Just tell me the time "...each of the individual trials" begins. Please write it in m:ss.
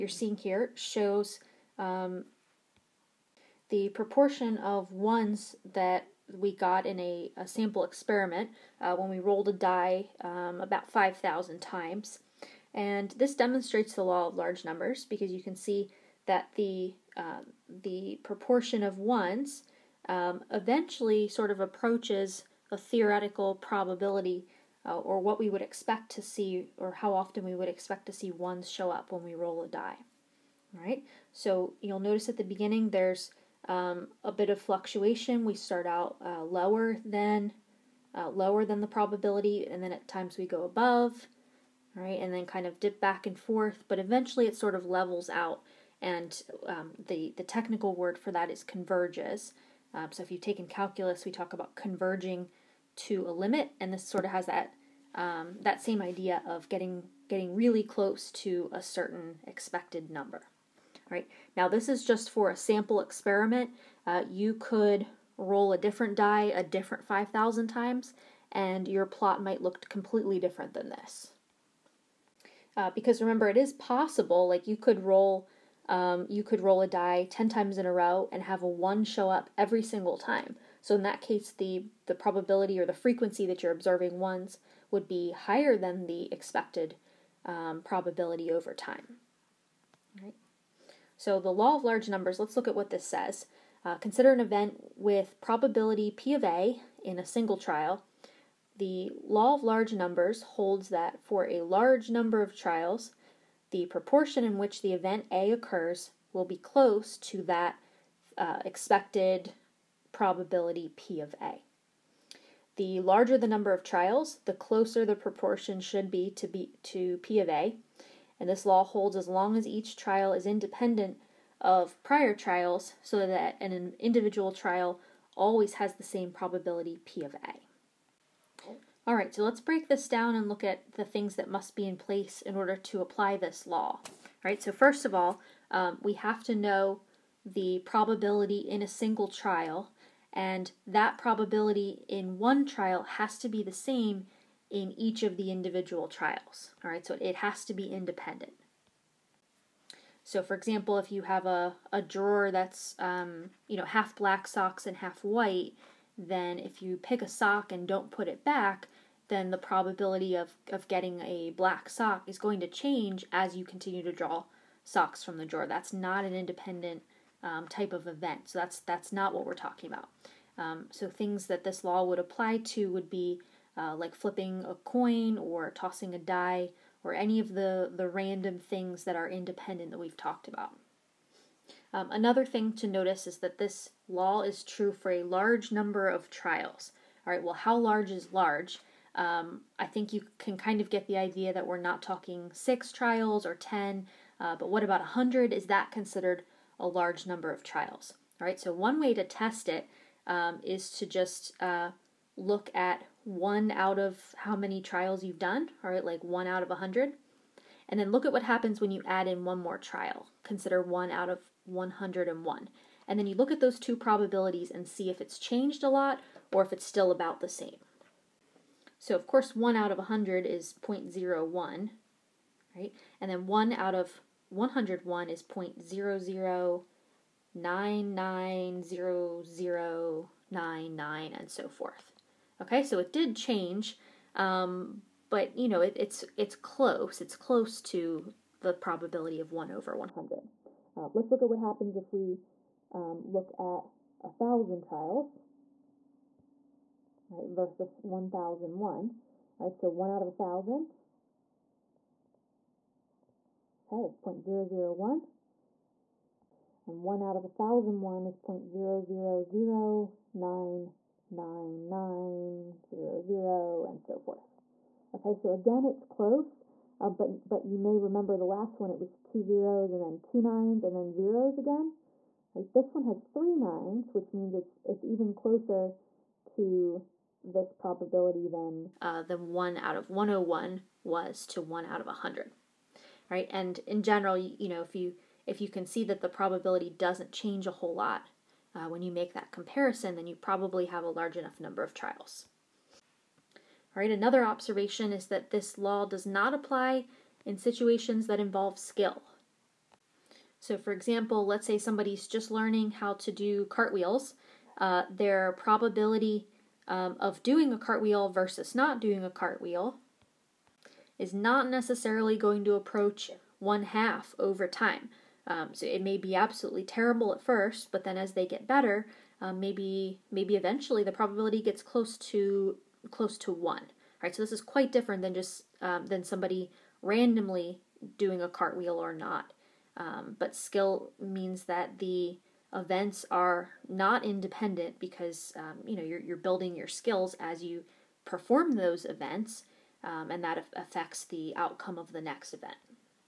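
2:24.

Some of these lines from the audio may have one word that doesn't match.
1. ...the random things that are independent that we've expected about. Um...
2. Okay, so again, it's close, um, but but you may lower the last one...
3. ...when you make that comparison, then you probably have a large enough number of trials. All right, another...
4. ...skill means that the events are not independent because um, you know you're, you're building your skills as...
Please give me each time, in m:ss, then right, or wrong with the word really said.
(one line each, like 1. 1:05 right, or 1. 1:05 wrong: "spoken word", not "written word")
1. 2:57 wrong: "talked", not "expected"
2. 4:25 wrong: "remember", not "lower"
3. 4:48 right
4. 5:30 right.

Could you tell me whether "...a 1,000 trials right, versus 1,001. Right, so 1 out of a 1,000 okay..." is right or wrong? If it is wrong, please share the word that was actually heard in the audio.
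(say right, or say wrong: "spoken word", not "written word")
right.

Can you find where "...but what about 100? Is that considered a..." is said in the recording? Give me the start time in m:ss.
3:14.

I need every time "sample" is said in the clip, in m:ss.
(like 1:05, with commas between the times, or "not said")
0:07, 1:02.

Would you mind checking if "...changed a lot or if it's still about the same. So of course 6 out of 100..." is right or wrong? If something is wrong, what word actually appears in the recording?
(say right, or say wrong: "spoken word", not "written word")
wrong: "1", not "6".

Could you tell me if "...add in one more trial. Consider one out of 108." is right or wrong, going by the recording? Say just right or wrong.
wrong.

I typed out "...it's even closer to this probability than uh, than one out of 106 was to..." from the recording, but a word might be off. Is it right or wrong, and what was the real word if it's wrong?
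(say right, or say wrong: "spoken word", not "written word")
wrong: "101", not "106".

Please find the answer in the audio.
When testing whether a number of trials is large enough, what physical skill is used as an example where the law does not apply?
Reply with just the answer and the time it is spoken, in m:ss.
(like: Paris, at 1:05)
cartwheels, at 5:03.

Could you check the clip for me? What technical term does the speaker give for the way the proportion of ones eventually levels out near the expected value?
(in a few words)
converges.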